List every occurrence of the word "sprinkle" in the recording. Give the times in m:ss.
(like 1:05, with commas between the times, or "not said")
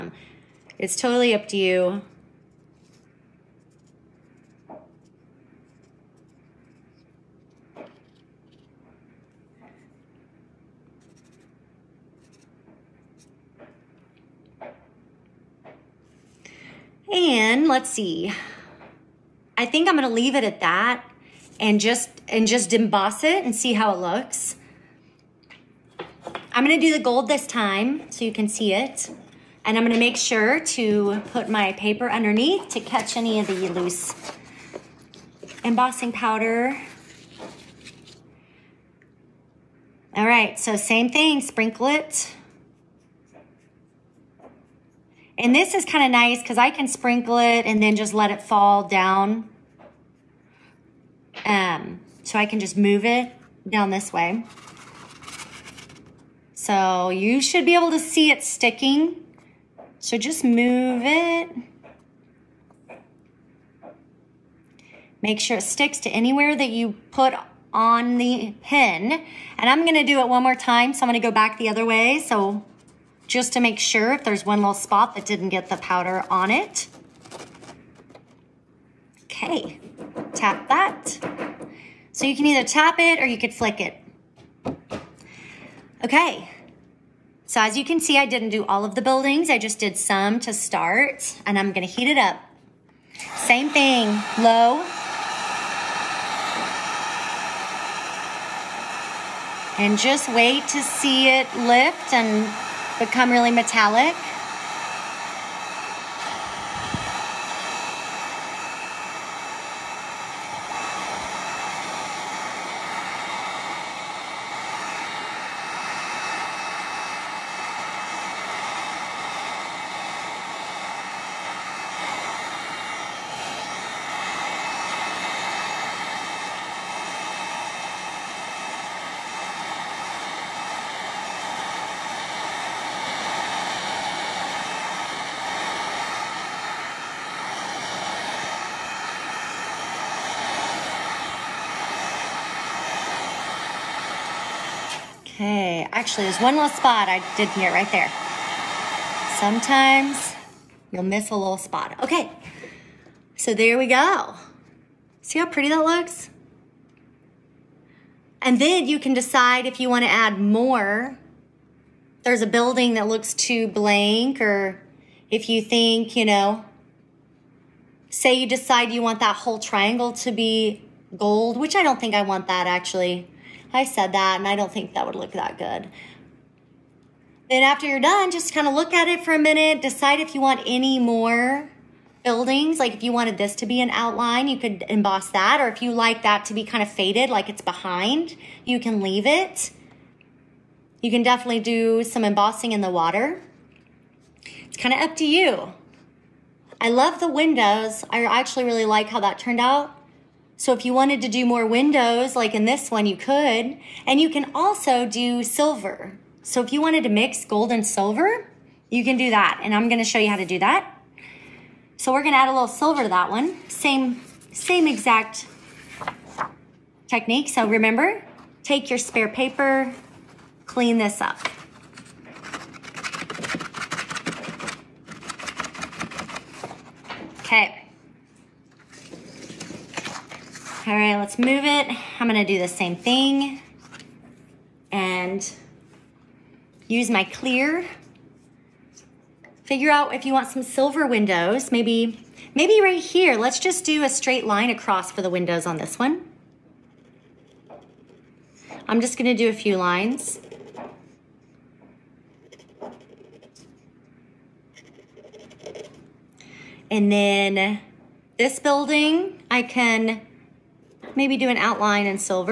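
0:41, 0:46.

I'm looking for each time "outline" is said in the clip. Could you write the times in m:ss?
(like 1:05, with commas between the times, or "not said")
3:03, 4:21.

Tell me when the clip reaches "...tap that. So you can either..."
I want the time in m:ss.
1:20.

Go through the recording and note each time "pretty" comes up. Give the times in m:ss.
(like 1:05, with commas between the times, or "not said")
2:35.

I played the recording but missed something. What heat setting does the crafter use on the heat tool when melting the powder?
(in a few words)
Low.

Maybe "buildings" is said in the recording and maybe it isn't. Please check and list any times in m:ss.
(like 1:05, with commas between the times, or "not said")
1:29, 2:42, 3:02, 4:18.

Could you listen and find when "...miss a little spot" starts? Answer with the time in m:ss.
2:31.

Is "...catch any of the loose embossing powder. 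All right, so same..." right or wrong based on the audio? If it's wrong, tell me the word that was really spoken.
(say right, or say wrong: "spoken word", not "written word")
right.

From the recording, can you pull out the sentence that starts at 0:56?
So you should be able to see it sticking.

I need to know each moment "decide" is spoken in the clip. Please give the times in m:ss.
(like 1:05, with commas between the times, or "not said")
2:39, 2:48, 2:59.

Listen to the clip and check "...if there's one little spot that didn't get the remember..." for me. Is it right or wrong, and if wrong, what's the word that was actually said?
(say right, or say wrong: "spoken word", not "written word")
wrong: "powder", not "remember".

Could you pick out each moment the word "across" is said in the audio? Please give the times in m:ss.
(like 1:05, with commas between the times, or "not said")
4:04.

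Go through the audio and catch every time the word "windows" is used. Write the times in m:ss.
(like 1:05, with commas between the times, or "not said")
3:17, 3:21, 4:01, 4:05.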